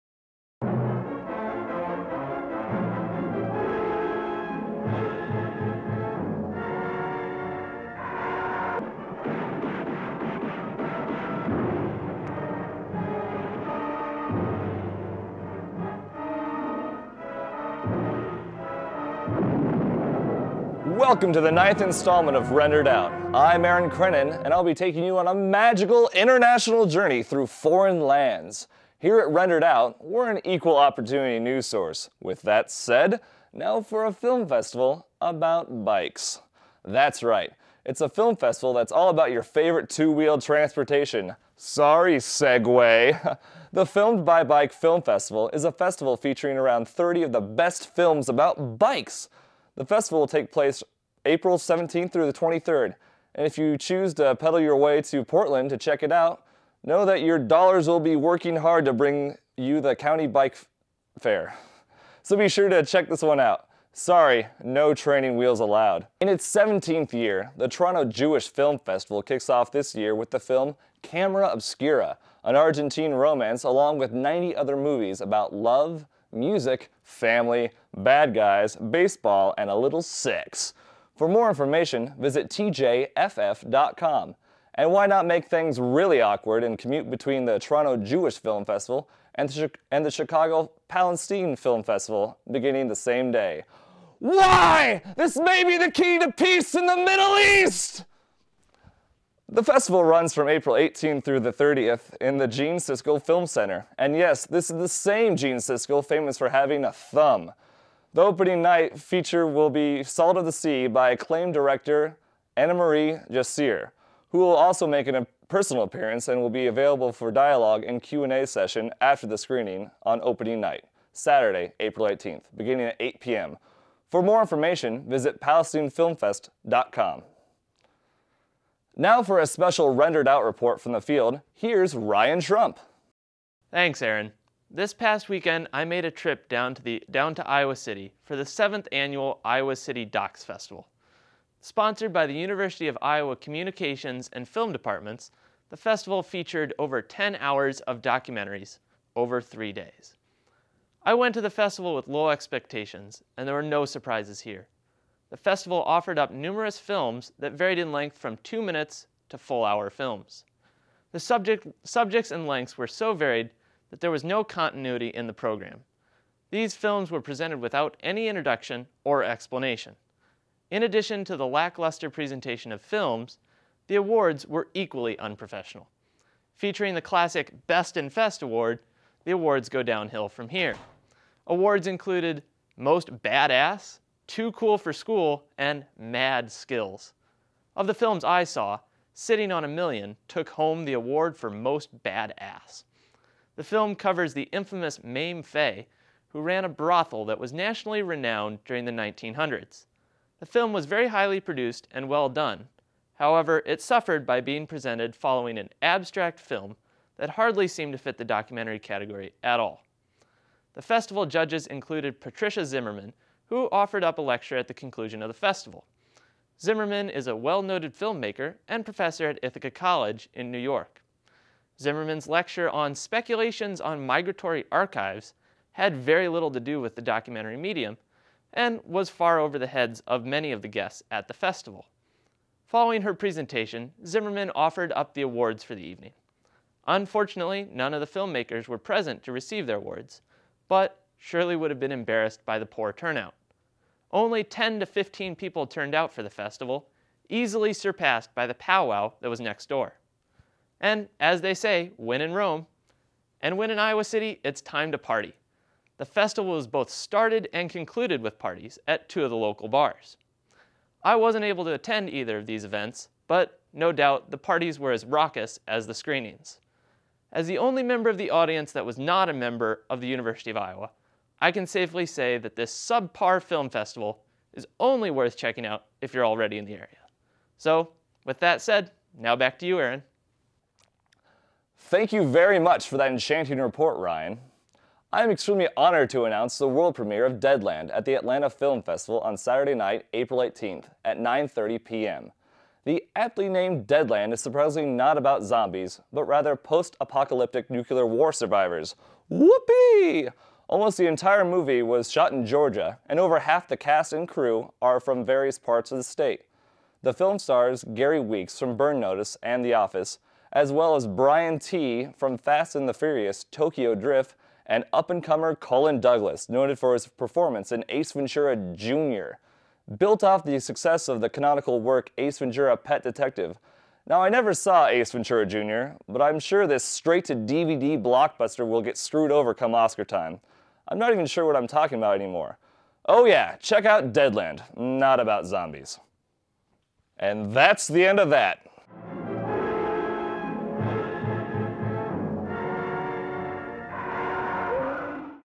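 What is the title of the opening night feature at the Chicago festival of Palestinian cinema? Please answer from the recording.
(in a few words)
Salt of the Sea.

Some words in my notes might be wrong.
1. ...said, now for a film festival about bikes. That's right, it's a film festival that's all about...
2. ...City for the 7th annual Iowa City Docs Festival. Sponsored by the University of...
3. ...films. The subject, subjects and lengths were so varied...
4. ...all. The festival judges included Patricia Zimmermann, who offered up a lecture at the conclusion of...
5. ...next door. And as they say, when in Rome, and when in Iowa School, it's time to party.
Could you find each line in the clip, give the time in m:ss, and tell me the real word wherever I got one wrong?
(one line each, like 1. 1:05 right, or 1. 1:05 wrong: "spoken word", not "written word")
1. 0:32 right
2. 2:17 right
3. 2:39 right
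4. 3:29 right
5. 4:09 wrong: "City", not "School".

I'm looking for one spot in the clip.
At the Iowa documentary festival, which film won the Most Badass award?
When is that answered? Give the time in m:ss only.
3:09.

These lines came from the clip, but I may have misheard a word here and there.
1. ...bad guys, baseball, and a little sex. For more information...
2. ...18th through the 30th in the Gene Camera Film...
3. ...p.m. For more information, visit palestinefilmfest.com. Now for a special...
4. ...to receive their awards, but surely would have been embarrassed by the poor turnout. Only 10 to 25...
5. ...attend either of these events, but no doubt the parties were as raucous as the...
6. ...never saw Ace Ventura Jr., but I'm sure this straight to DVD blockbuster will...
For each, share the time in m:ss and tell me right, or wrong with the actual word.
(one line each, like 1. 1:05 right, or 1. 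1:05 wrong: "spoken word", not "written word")
1. 1:17 right
2. 1:40 wrong: "Siskel", not "Camera"
3. 2:03 right
4. 3:59 wrong: "15", not "25"
5. 4:21 right
6. 5:24 right.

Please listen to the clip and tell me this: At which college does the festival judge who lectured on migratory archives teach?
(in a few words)
Ithaca College.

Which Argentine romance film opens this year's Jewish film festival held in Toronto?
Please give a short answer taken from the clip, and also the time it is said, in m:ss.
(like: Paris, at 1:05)
Camera Obscura, at 1:11.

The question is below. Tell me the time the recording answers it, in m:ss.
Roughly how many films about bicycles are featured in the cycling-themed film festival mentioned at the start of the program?
0:46.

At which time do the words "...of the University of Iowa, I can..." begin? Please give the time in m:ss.
4:29.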